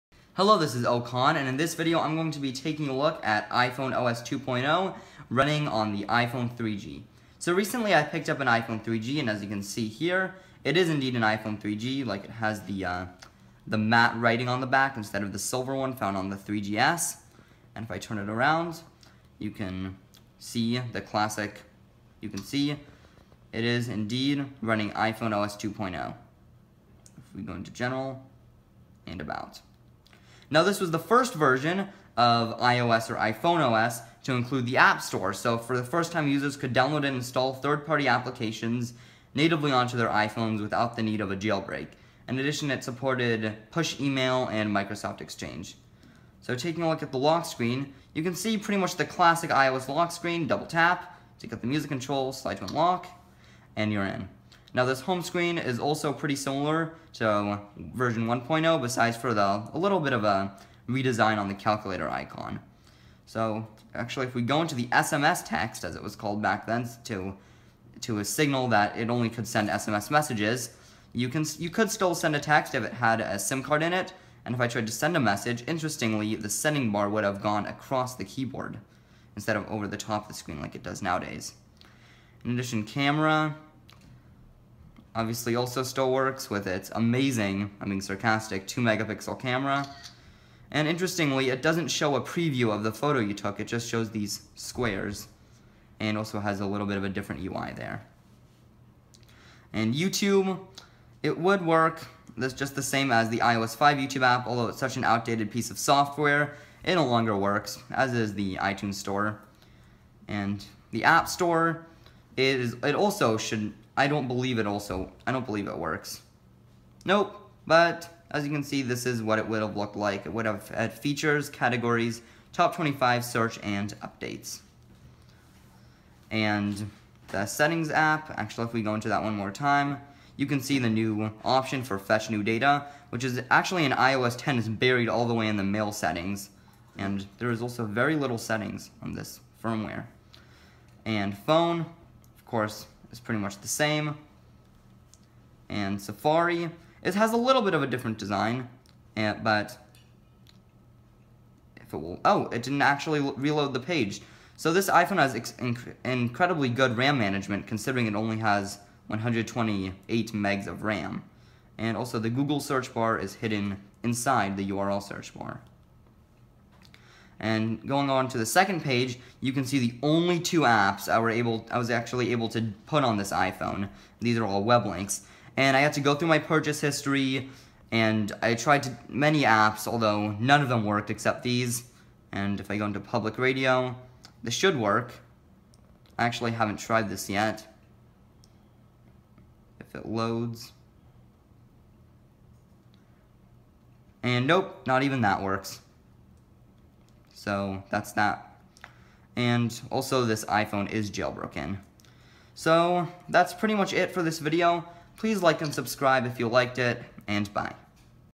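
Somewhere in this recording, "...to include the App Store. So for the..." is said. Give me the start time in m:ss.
0:34.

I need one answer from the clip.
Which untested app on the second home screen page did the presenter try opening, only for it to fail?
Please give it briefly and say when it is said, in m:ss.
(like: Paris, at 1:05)
Public radio, at 3:02.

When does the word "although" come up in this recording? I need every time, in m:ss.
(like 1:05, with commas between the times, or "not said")
1:44, 2:59.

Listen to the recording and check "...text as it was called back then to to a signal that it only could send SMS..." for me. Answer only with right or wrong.
right.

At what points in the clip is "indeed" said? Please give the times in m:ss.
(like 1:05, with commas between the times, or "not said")
0:10, 0:23.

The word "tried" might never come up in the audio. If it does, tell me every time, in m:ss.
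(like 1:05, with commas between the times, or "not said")
1:14, 2:58, 3:06.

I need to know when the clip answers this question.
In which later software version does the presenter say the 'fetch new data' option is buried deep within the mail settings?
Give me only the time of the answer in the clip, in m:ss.
2:13.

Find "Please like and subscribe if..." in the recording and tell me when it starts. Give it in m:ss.
3:25.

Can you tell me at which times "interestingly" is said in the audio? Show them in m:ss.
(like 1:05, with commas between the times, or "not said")
1:15, 1:30.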